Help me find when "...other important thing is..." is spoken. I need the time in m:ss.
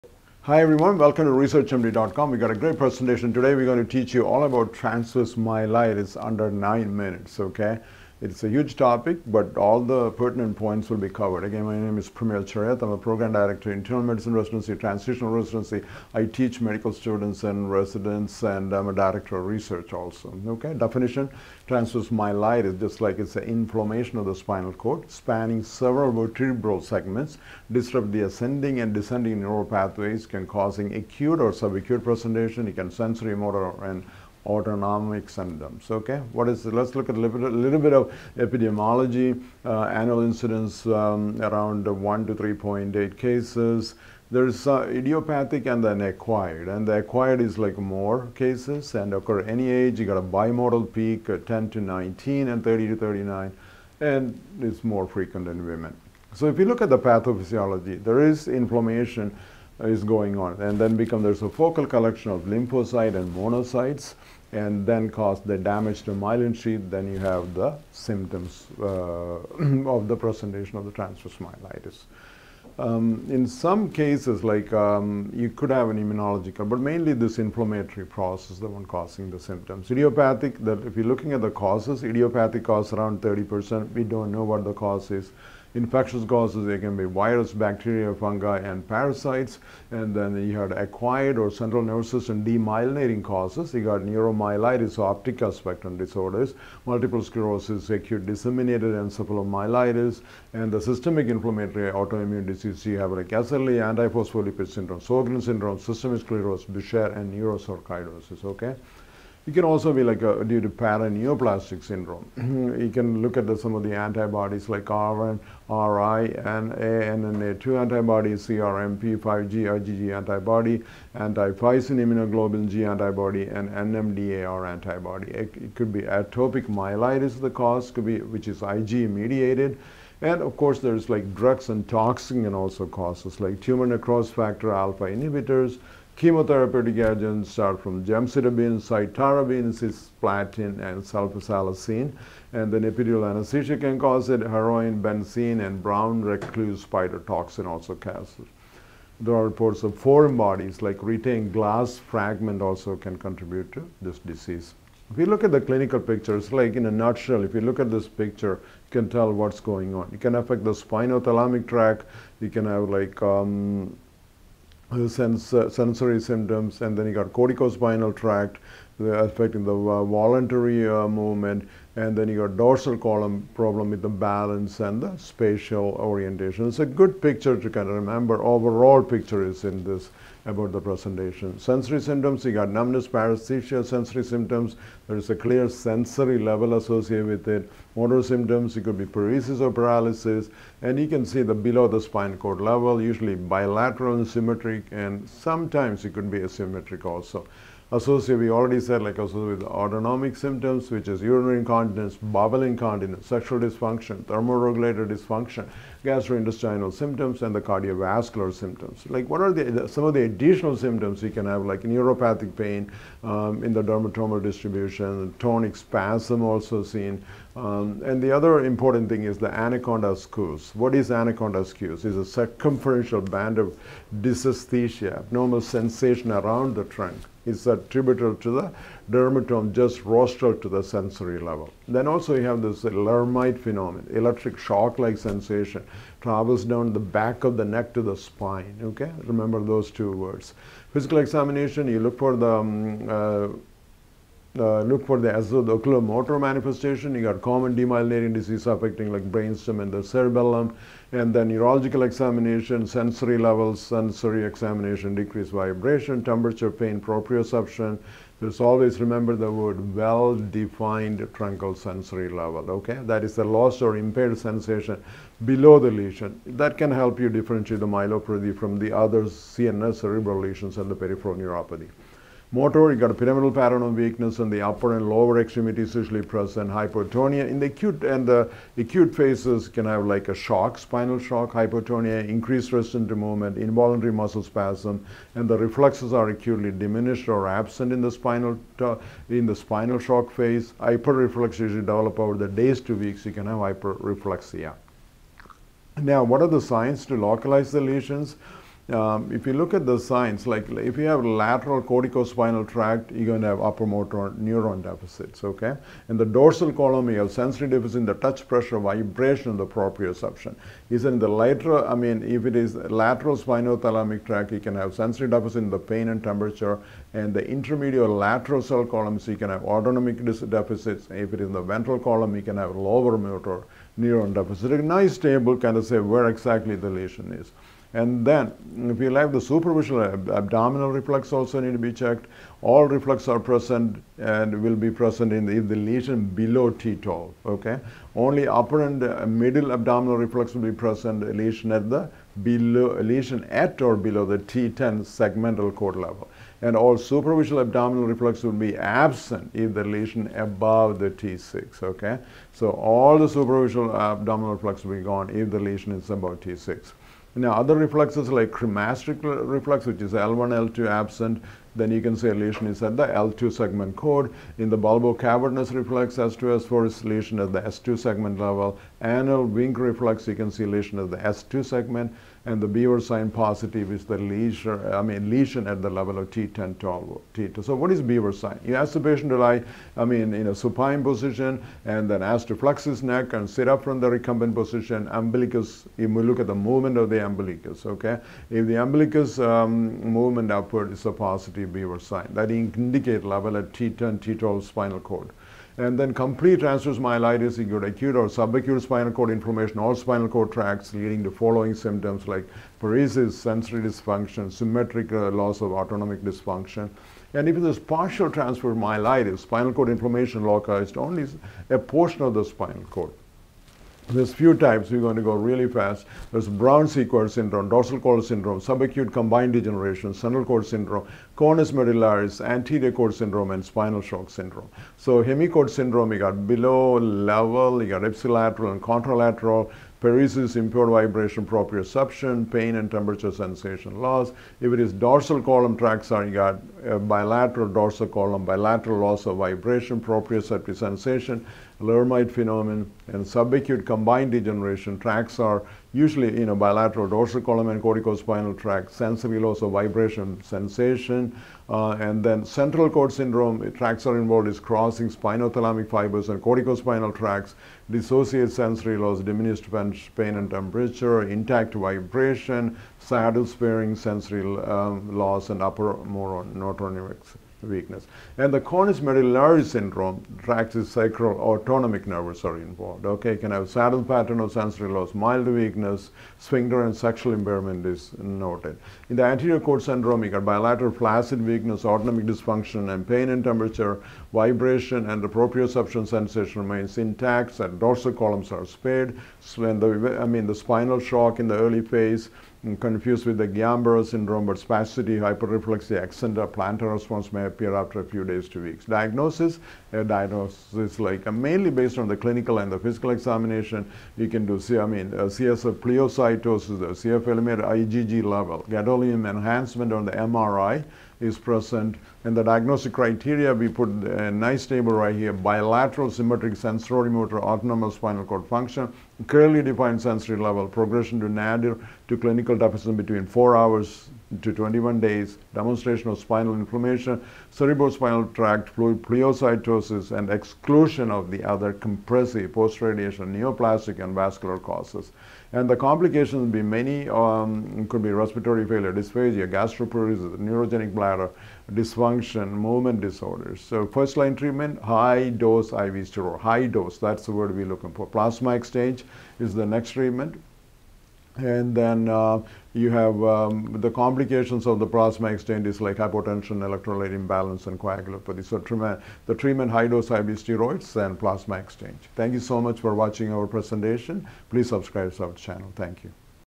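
3:38.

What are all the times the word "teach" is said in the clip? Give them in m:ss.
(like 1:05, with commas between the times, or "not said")
0:03, 0:16.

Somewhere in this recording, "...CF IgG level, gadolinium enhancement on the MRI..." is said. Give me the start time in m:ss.
8:26.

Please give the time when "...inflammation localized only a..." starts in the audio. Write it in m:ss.
6:49.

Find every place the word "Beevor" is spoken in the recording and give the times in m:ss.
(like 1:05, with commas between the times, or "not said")
6:12, 6:18, 6:31.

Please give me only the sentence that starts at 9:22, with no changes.
Thank you so much for watching our presentation.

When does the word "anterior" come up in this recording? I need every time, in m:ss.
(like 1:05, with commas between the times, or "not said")
7:02, 7:59.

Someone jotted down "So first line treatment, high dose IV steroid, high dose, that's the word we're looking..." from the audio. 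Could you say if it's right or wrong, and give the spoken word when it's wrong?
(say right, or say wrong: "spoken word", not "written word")
right.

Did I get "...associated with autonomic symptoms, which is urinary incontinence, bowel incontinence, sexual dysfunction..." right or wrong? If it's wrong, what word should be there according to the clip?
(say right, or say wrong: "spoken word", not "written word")
right.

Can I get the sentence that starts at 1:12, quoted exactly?
Um, in some cases, like um, you could have an immunological, but mainly this inflammatory process, the one causing the symptoms.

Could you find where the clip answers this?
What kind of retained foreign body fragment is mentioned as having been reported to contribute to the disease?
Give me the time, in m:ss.
2:31.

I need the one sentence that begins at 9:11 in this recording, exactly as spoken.
And then uh, you have um, the complications of the plasma exchange is like hypotension, electrolyte imbalance, and coagulopathy.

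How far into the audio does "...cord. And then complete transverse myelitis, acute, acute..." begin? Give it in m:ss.
6:34.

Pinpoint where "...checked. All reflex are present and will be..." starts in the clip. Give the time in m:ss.
5:31.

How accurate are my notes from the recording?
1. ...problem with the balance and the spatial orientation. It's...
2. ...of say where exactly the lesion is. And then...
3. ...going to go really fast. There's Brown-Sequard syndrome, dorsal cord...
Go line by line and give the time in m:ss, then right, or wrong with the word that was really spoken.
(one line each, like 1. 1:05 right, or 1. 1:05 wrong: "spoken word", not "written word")
1. 2:53 right
2. 5:25 right
3. 6:54 right.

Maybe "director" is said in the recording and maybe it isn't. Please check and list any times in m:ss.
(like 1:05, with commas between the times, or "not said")
0:13, 0:18.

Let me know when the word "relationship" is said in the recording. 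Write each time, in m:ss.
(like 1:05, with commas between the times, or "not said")
not said.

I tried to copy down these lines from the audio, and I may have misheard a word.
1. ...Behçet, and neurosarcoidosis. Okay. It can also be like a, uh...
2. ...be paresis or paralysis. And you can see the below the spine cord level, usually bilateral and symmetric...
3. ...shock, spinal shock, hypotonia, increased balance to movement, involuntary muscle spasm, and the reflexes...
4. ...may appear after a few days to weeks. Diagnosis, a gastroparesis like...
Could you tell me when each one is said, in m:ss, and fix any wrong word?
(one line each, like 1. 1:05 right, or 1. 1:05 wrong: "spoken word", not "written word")
1. 1:46 right
2. 3:08 right
3. 4:40 wrong: "resistance", not "balance"
4. 8:17 wrong: "diagnosis", not "gastroparesis".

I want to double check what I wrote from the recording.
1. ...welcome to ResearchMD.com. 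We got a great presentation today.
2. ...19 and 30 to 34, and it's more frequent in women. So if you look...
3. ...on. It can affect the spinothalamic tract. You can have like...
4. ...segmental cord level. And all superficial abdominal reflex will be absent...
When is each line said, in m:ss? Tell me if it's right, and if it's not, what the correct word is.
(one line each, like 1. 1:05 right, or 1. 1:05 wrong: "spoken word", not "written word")
1. 0:00 right
2. 0:51 wrong: "39", not "34"
3. 2:39 right
4. 5:45 right.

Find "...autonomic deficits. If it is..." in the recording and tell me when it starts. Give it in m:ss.
5:19.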